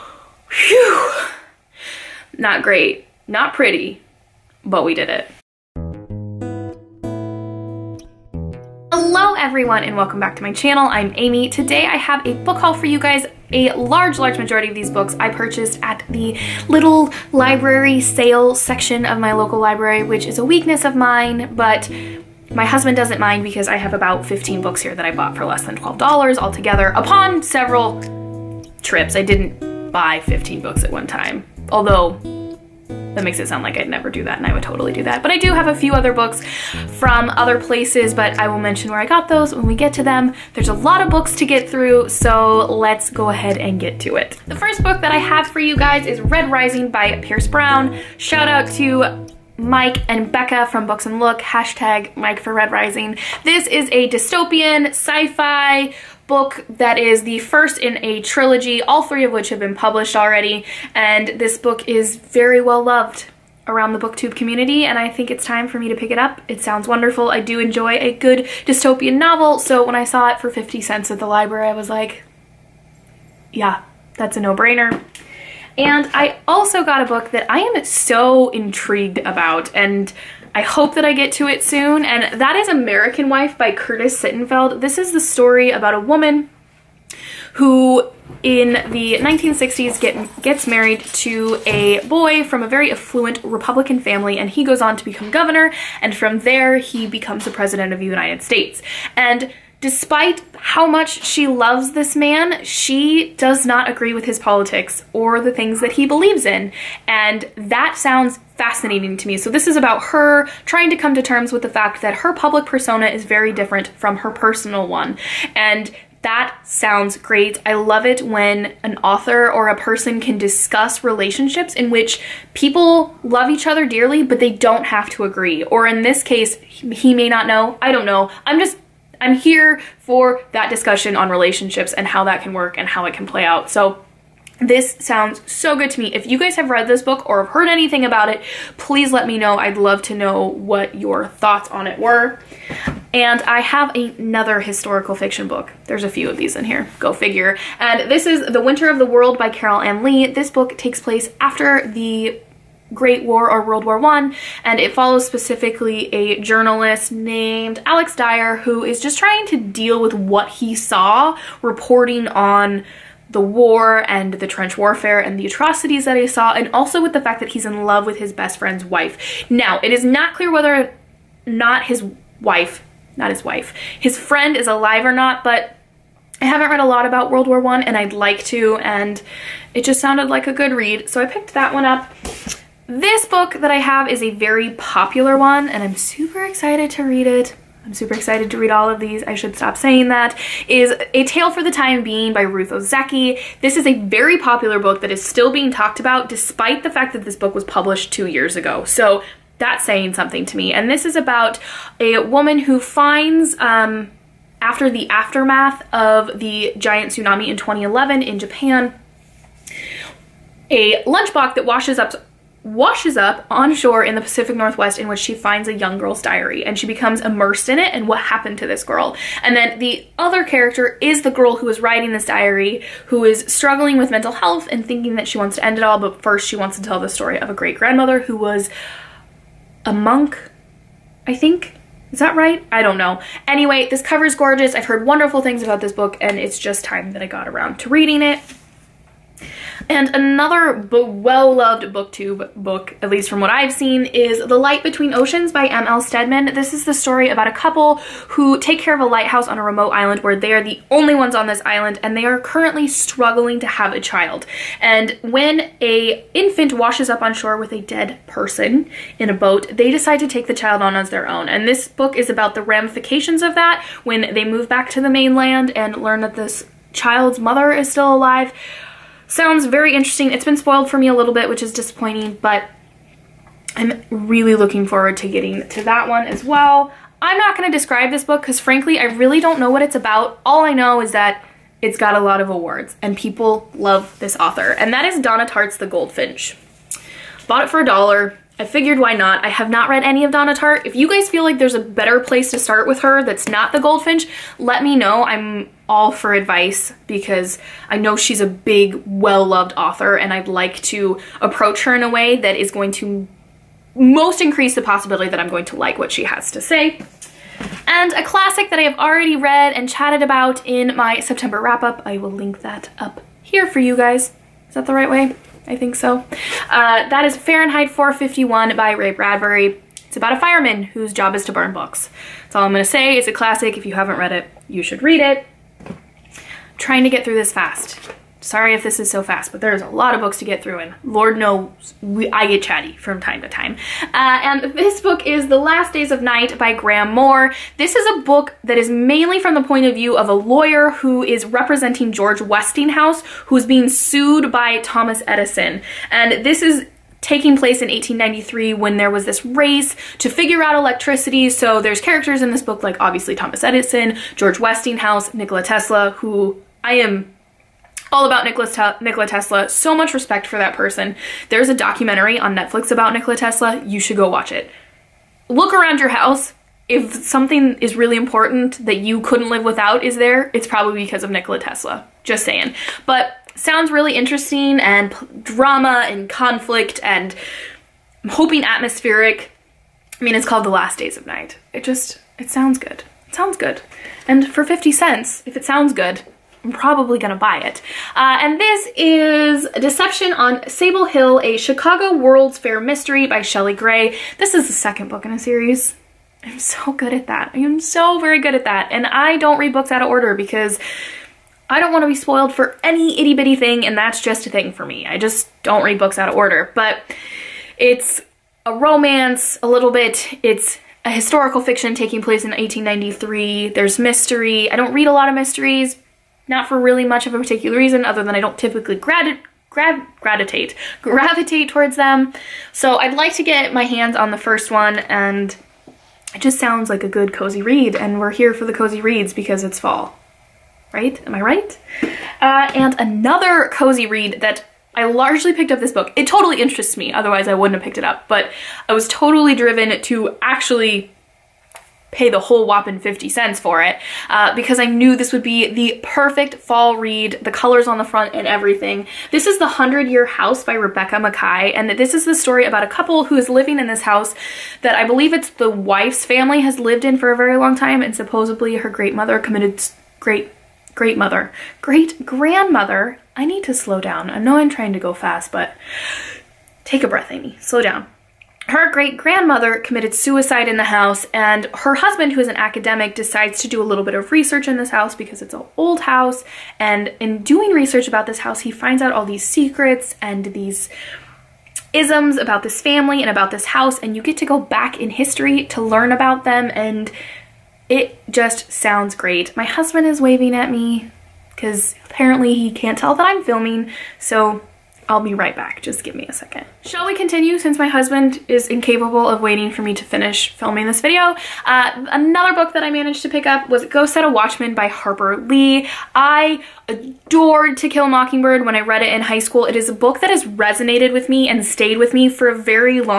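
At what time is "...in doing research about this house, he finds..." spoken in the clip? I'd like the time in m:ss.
7:57.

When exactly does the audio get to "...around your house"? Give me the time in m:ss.
6:05.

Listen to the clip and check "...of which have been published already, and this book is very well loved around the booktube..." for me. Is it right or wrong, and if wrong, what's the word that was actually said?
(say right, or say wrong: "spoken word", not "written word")
right.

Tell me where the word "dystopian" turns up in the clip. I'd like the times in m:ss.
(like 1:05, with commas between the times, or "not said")
0:54, 1:08.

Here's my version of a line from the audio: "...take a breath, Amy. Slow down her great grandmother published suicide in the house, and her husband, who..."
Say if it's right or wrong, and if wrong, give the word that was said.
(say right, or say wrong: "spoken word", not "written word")
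wrong: "committed", not "published".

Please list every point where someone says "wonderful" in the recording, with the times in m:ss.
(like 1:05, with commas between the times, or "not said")
1:06, 3:55.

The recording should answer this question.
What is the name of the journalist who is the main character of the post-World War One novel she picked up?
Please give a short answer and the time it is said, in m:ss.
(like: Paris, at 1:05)
Alex Dyer, at 2:37.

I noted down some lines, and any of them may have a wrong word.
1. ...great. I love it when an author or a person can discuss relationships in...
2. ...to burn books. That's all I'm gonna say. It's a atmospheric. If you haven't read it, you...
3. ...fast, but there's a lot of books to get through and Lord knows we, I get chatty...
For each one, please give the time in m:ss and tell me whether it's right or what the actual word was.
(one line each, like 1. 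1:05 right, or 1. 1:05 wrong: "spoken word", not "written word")
1. 1:57 right
2. 5:21 wrong: "classic", not "atmospheric"
3. 5:29 right.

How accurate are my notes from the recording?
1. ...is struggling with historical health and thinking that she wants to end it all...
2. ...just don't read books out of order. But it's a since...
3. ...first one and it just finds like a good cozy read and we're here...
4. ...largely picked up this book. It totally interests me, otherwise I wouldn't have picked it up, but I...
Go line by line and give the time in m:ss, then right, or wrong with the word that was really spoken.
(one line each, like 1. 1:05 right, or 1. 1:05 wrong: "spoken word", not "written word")
1. 3:43 wrong: "mental", not "historical"
2. 6:45 wrong: "romance", not "since"
3. 7:04 wrong: "sounds", not "finds"
4. 7:15 right.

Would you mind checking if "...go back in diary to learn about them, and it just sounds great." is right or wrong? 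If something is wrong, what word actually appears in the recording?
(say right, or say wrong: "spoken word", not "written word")
wrong: "history", not "diary".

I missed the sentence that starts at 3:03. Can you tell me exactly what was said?
This book that I have is a very popular one and I'm super excited to read it.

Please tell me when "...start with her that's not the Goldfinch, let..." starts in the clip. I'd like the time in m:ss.
4:52.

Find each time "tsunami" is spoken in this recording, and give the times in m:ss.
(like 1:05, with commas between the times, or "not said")
3:27.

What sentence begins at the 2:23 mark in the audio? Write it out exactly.
And I have another historical fiction book.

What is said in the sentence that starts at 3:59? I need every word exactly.
And another well-loved booktube book, at least from what I've seen, is The Light Between Oceans by M.L.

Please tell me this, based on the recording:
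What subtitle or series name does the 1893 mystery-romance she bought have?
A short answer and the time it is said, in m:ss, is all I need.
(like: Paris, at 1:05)
A Chicago World's Fair Mystery, at 6:31.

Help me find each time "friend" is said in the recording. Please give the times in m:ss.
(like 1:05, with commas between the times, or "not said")
2:48, 2:54.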